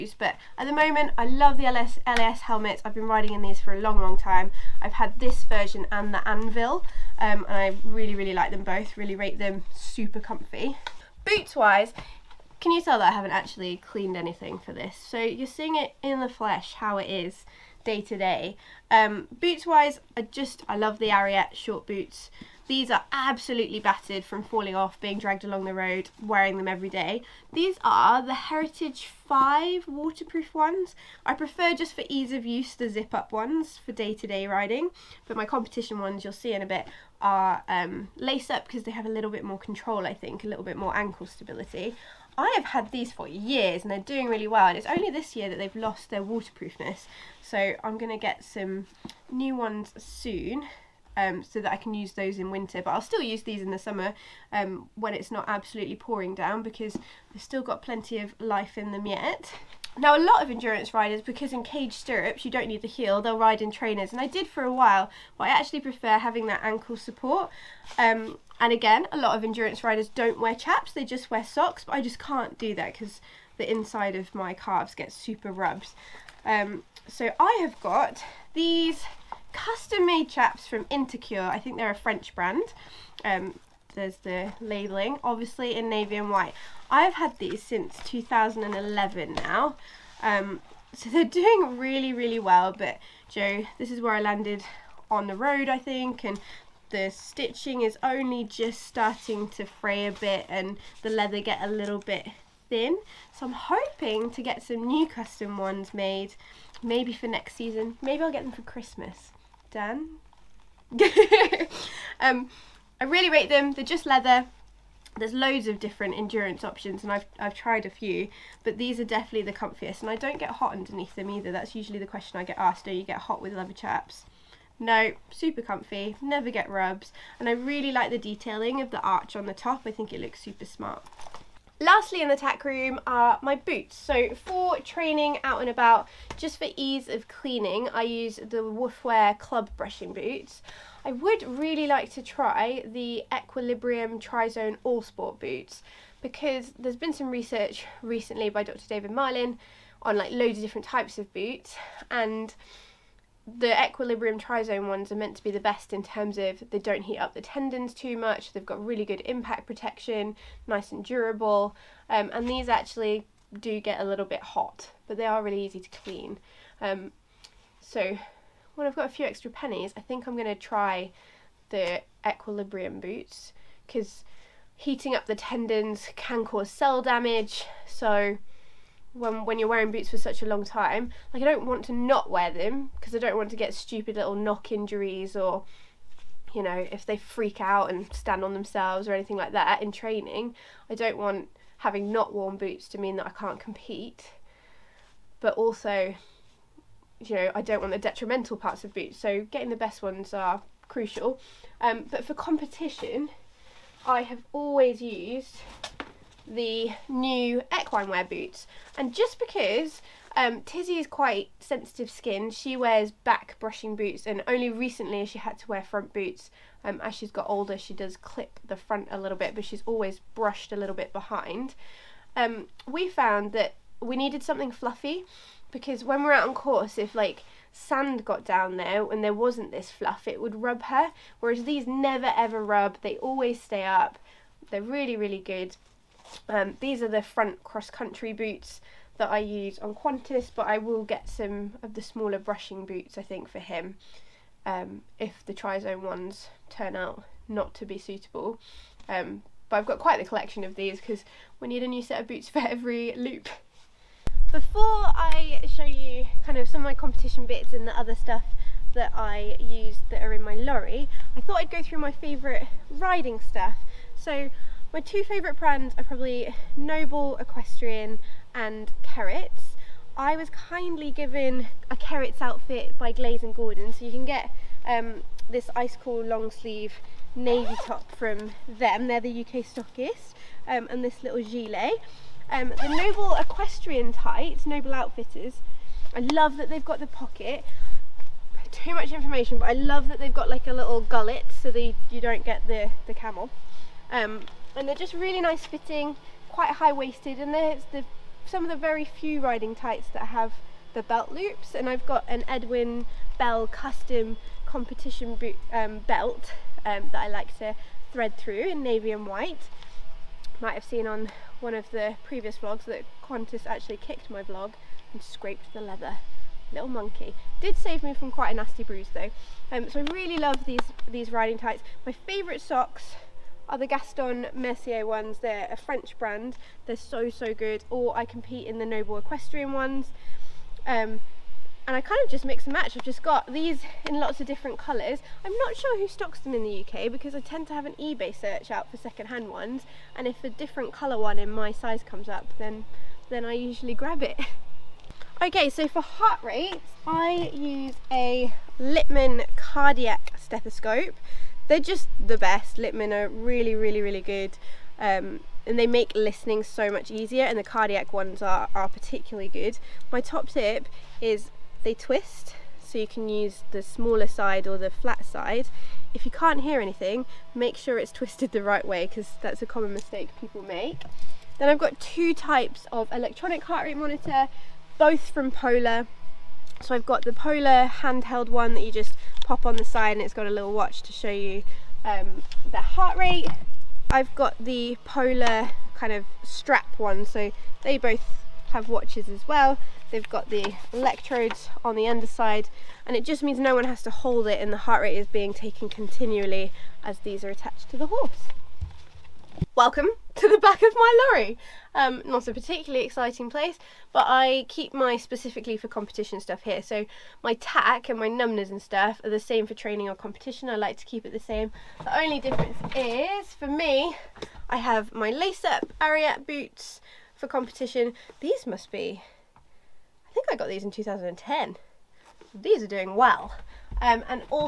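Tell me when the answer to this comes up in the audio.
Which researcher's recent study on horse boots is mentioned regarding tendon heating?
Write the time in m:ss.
2:28.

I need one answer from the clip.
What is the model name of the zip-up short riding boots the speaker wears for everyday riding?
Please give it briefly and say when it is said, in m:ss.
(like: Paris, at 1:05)
Heritage 5, at 0:28.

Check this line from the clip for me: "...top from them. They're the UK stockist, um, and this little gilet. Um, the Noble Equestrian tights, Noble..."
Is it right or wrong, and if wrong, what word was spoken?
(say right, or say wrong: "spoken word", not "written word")
right.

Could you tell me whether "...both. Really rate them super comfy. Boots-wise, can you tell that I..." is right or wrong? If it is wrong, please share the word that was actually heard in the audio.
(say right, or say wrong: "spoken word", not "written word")
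right.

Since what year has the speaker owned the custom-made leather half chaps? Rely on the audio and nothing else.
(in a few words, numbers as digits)
2011.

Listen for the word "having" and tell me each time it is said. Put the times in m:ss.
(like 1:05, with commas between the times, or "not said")
1:06, 3:11.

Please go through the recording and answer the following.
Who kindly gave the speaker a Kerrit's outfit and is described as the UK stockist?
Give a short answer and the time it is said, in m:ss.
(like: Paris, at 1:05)
Glaze and Gordon, at 4:33.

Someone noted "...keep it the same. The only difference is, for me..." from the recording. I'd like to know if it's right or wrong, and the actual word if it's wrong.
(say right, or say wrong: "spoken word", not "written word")
right.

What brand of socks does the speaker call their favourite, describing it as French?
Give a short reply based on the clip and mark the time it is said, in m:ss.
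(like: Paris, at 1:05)
Gaston Mercier, at 5:23.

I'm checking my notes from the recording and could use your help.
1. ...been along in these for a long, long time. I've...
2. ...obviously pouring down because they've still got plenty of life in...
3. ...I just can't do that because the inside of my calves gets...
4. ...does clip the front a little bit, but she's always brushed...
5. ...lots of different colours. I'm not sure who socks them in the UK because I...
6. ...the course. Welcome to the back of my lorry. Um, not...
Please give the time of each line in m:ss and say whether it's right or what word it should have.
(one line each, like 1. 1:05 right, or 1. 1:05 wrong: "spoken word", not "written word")
1. 0:02 wrong: "riding", not "along"
2. 0:55 wrong: "absolutely", not "obviously"
3. 1:11 right
4. 3:37 right
5. 5:34 wrong: "stocks", not "socks"
6. 6:37 wrong: "horse", not "course".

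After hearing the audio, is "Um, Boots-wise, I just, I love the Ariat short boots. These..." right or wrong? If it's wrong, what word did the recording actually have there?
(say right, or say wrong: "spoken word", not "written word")
right.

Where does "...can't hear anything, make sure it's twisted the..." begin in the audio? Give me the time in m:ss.
6:06.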